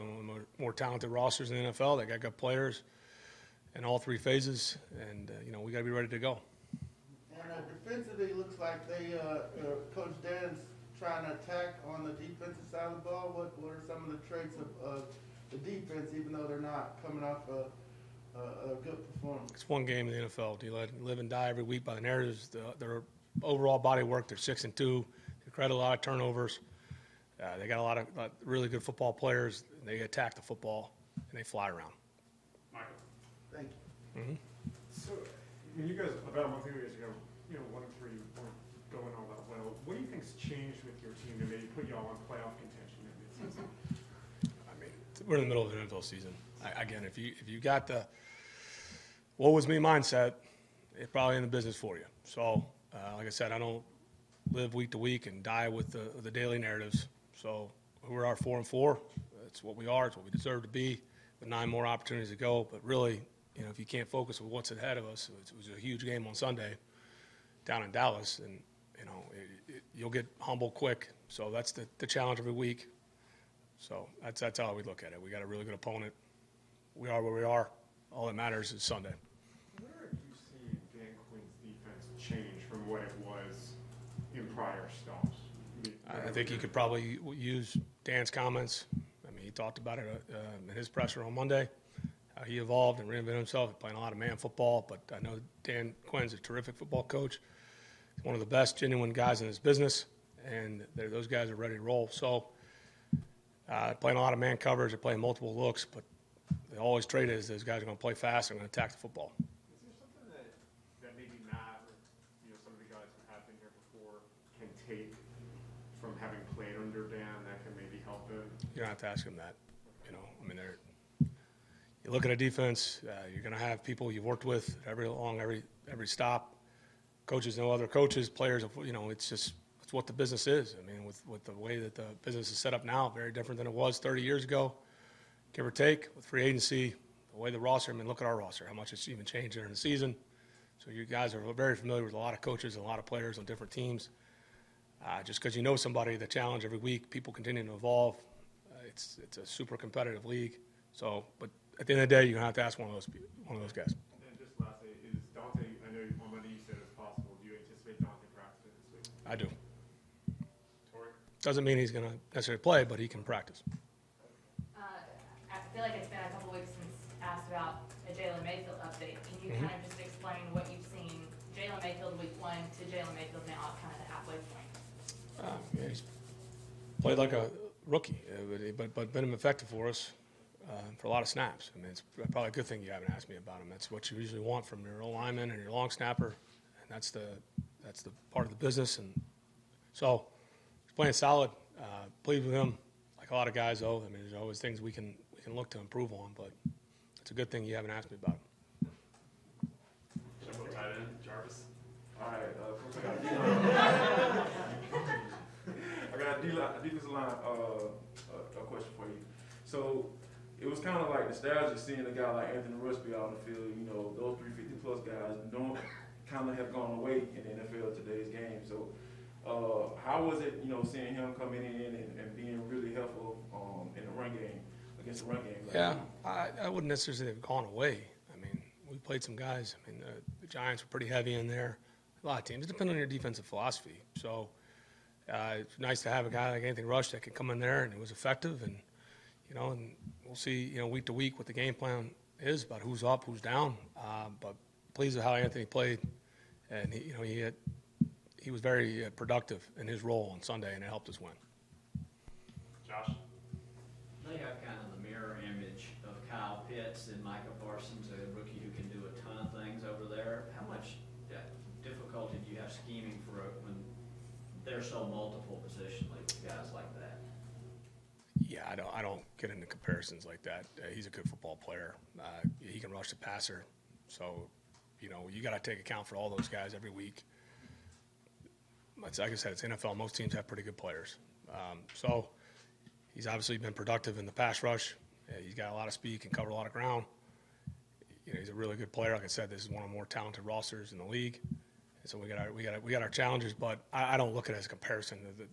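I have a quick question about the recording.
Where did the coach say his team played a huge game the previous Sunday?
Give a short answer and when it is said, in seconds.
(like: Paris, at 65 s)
Dallas, at 67 s.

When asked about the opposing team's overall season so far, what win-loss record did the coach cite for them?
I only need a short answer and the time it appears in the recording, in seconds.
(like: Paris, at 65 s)
6-2, at 24 s.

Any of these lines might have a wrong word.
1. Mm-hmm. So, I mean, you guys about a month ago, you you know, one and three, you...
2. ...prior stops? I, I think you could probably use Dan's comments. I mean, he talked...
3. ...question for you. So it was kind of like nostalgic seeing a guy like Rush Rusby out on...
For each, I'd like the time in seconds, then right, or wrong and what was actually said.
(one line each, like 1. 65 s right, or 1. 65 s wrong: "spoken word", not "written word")
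1. 34 s right
2. 84 s right
3. 208 s wrong: "Anthony", not "Rush".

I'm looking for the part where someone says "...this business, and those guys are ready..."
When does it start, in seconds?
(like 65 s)
99 s.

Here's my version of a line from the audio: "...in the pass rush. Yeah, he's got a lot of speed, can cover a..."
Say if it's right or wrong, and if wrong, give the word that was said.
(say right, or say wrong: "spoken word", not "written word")
right.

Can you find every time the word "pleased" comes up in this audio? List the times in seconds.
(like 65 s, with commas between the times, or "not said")
192 s, 244 s.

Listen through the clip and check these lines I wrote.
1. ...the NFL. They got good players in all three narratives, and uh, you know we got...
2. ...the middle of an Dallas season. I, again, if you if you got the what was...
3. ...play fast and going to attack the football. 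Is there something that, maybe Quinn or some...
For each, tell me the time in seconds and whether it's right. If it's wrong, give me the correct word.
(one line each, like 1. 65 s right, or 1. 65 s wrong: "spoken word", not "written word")
1. 1 s wrong: "phases", not "narratives"
2. 45 s wrong: "NFL", not "Dallas"
3. 108 s wrong: "Matt", not "Quinn".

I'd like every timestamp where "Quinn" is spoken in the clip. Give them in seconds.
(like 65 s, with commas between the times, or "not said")
81 s, 96 s.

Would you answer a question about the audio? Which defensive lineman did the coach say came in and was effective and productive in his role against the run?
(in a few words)
Anthony Rush.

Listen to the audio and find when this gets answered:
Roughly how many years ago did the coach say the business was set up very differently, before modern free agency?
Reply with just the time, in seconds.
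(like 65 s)
133 s.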